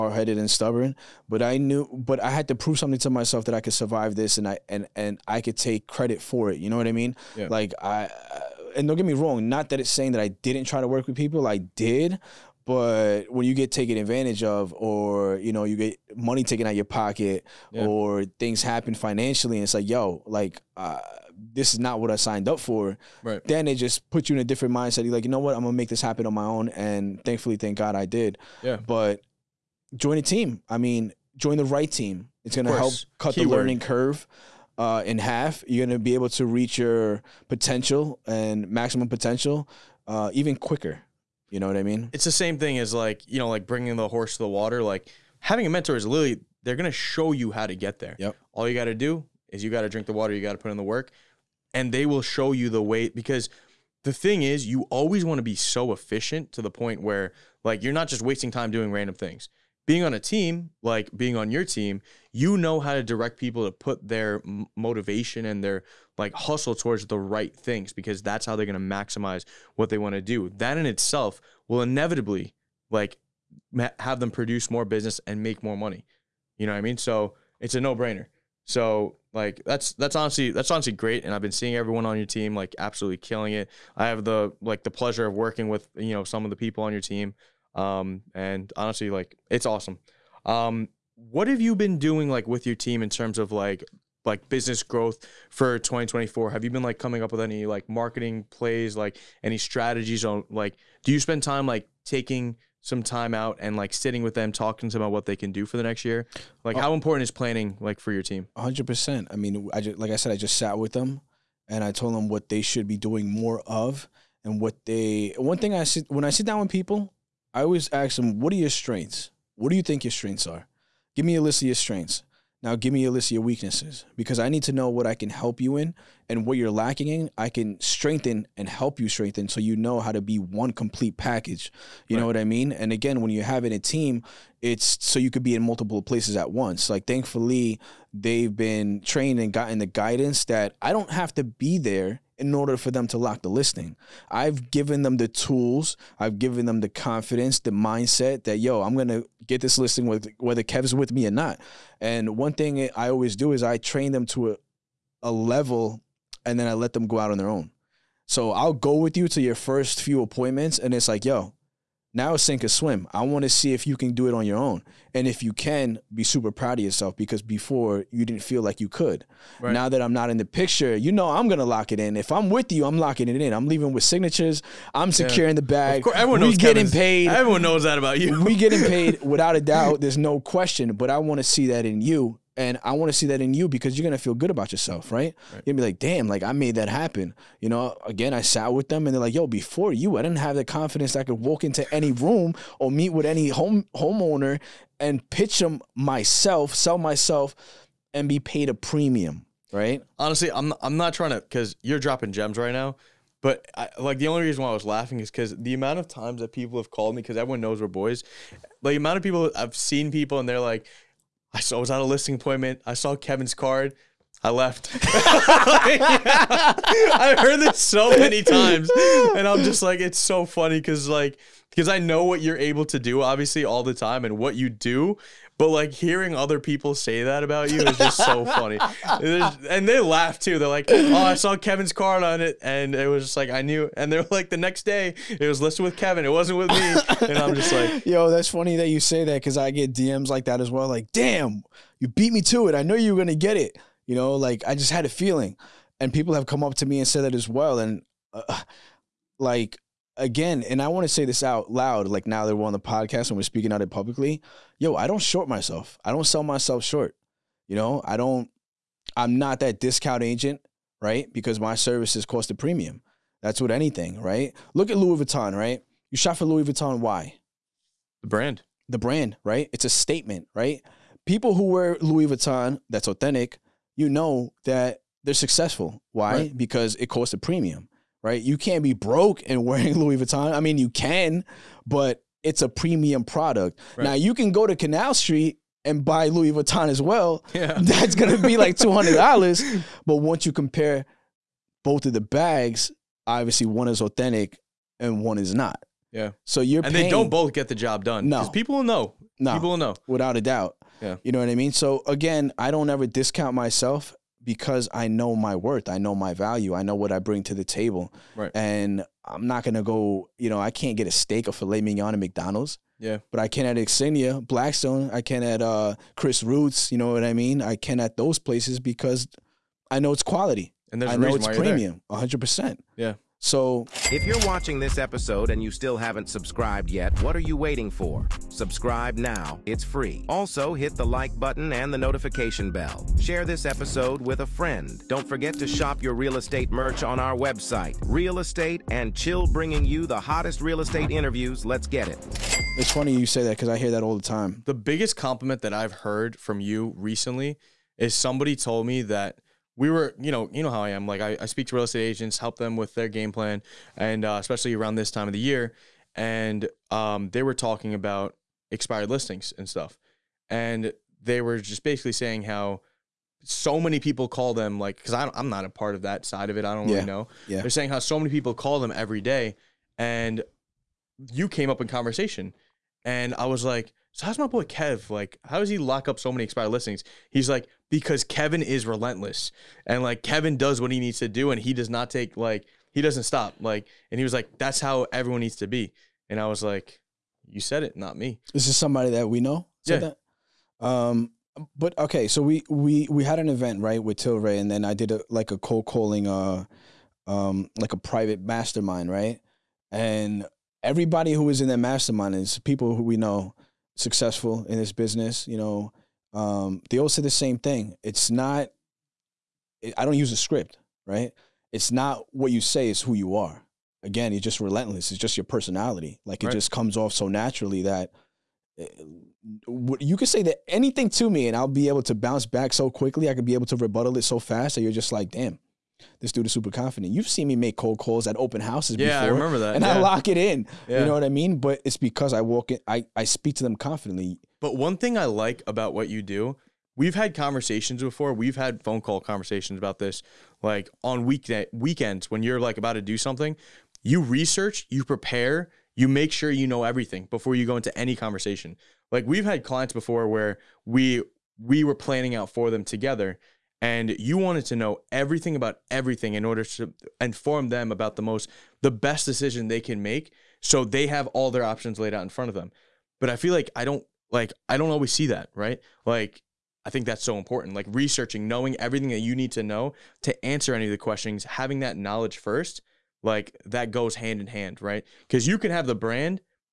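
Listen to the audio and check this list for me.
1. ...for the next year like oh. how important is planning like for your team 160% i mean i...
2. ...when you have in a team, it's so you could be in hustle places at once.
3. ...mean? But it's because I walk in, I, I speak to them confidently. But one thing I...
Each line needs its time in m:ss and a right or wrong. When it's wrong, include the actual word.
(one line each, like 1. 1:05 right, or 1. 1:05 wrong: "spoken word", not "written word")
1. 1:45 wrong: "100", not "160"
2. 2:13 wrong: "multiple", not "hustle"
3. 7:11 right.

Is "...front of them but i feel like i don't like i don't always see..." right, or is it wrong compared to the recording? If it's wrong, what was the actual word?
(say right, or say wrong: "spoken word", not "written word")
right.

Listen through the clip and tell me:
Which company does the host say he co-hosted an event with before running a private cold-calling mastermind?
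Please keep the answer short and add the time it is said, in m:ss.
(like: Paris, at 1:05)
Tilray, at 6:34.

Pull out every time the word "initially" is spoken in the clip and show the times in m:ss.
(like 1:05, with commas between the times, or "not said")
not said.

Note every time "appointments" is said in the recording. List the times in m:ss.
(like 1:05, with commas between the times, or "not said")
2:40, 3:32.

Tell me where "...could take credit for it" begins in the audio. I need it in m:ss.
0:05.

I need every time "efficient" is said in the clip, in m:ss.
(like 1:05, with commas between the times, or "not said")
0:55.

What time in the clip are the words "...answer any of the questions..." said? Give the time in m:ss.
7:50.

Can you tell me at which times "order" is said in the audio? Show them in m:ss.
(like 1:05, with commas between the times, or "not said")
2:22, 7:36.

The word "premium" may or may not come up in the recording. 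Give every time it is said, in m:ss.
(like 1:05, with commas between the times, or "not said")
3:18, 4:22, 4:37, 4:42, 5:21.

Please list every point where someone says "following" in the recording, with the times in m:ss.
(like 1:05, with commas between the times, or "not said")
not said.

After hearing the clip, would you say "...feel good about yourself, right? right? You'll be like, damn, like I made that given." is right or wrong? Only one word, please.
wrong.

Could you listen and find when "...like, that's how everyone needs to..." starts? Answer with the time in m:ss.
6:24.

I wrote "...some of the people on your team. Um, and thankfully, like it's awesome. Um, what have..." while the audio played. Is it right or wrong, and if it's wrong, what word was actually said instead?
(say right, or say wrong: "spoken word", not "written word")
wrong: "honestly", not "thankfully".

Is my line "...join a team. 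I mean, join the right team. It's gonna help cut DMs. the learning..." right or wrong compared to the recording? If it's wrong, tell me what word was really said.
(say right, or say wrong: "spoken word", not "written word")
wrong: "Keyword", not "DMs".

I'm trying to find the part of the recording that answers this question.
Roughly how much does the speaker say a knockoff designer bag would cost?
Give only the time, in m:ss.
4:48.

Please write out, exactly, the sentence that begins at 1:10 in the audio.
That in itself will inevitably like have them produce more business and make more money.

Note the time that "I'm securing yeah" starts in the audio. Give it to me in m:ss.
2:54.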